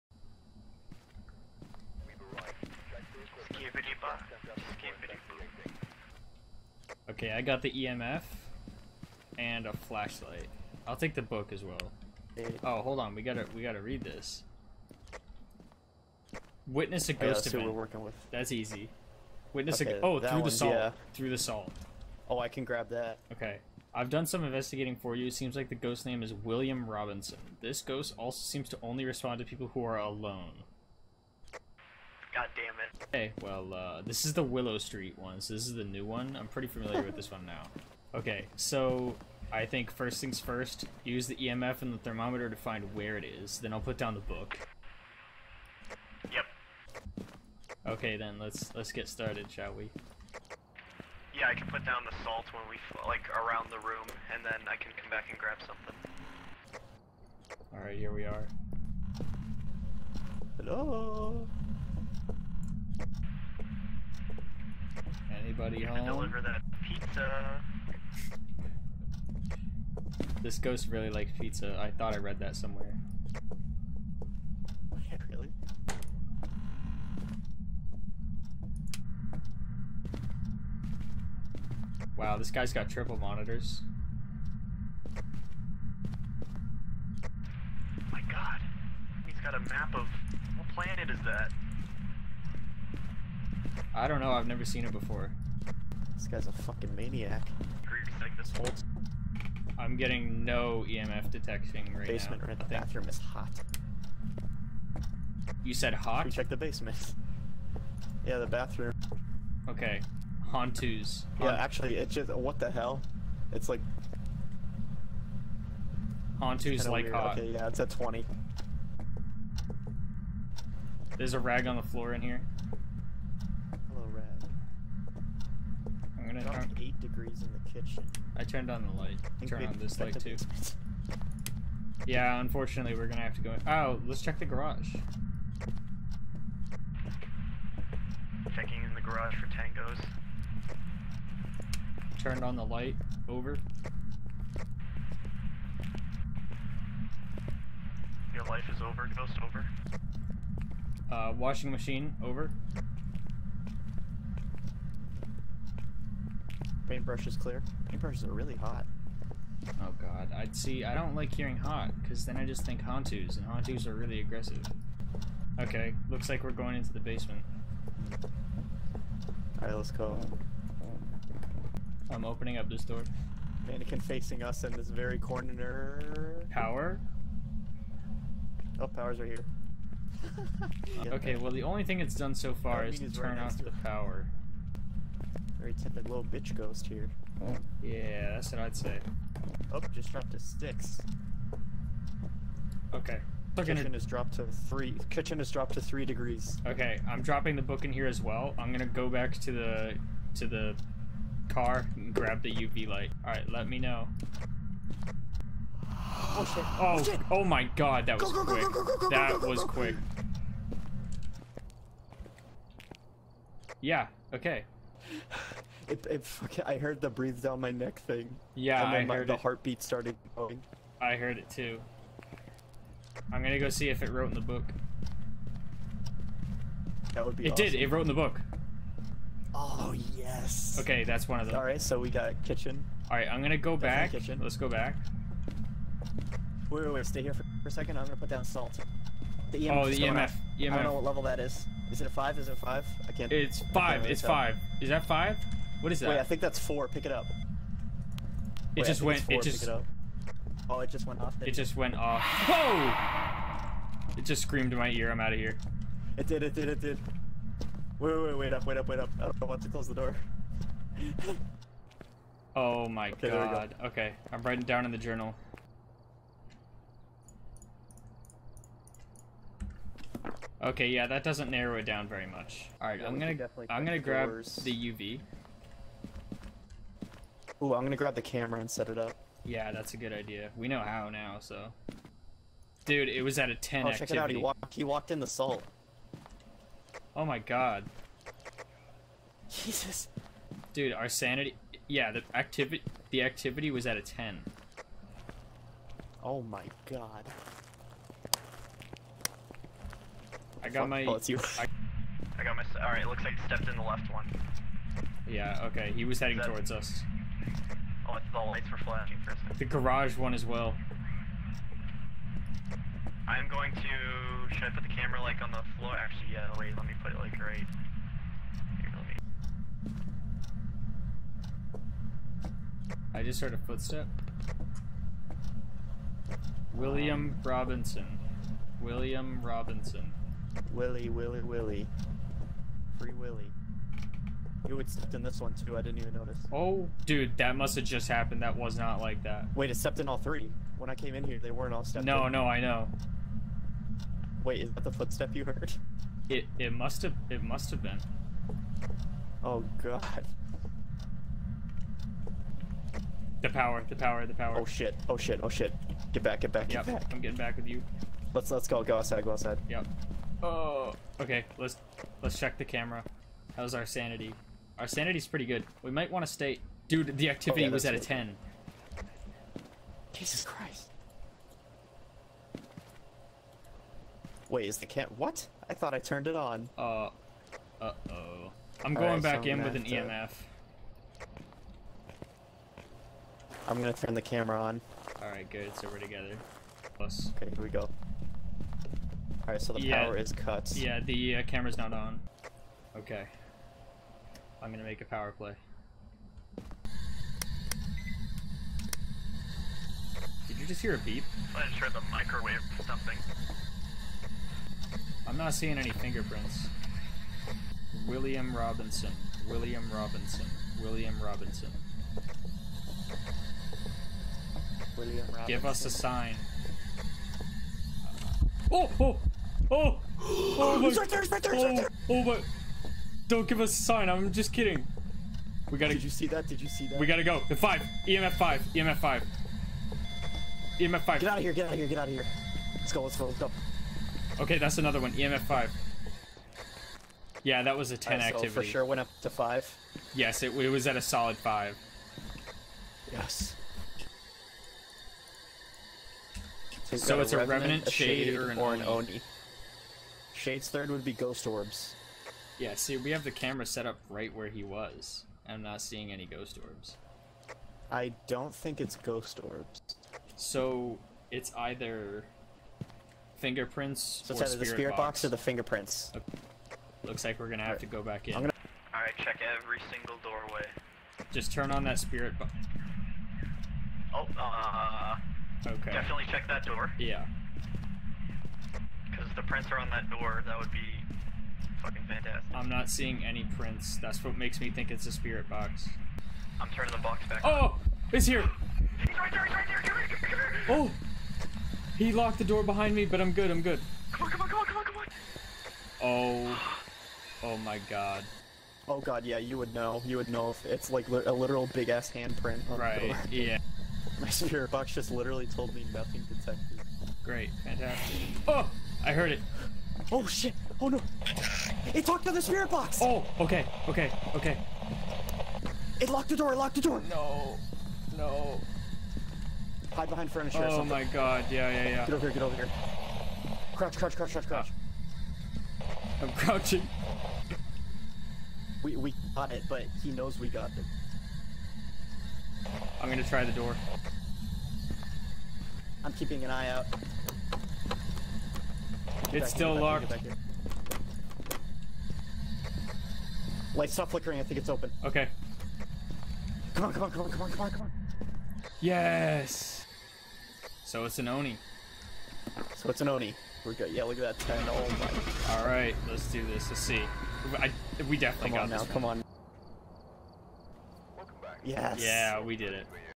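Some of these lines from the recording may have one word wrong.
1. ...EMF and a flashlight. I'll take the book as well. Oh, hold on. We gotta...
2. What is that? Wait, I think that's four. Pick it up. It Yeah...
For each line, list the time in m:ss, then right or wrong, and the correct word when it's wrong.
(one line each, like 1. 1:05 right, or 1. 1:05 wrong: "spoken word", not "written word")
1. 0:07 right
2. 4:05 wrong: "Wait", not "Yeah".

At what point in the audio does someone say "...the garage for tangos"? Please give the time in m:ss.
2:18.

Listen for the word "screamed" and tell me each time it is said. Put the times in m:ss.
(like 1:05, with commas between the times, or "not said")
4:14.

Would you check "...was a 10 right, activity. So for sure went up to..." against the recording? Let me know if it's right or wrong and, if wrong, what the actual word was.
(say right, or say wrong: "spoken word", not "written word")
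right.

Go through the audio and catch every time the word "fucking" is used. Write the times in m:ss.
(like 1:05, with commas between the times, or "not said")
1:36, 3:36, 8:01.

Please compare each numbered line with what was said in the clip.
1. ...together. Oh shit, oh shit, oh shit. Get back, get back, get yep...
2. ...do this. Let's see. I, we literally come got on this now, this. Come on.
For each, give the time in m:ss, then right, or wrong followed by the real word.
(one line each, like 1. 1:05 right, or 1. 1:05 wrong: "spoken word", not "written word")
1. 5:54 wrong: "power", not "together"
2. 9:16 wrong: "definitely", not "literally".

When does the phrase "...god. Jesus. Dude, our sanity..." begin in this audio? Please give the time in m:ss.
4:47.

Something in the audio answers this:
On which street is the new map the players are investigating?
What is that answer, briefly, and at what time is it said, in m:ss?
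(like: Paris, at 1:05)
Willow Street, at 0:34.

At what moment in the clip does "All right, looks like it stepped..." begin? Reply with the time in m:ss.
5:02.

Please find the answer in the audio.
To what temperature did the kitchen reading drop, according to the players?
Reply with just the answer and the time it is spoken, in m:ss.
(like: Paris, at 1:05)
3 degrees, at 3:15.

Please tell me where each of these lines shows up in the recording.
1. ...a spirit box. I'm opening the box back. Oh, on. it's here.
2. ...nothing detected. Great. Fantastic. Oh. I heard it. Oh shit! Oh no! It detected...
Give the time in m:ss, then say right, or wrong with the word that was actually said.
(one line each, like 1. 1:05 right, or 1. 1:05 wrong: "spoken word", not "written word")
1. 8:05 wrong: "turning", not "opening"
2. 8:25 wrong: "locked", not "detected".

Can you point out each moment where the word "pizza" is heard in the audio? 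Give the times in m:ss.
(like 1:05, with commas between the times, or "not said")
1:06, 1:11.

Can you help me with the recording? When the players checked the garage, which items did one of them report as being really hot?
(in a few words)
Paintbrushes.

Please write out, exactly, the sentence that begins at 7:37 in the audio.
I don't think it's ghost orbs.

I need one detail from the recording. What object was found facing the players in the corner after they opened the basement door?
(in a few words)
Mannequin.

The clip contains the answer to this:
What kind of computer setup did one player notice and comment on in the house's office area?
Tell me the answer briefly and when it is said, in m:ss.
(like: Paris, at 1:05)
triple monitors, at 1:22.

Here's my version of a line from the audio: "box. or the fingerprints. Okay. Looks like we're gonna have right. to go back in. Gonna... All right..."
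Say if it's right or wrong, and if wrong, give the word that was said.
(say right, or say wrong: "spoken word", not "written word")
right.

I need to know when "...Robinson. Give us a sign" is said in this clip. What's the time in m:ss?
6:55.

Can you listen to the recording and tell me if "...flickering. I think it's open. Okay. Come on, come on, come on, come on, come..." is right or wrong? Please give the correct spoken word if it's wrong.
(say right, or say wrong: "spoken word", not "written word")
right.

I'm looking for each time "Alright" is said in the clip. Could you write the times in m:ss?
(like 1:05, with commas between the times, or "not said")
2:49, 6:25, 6:29.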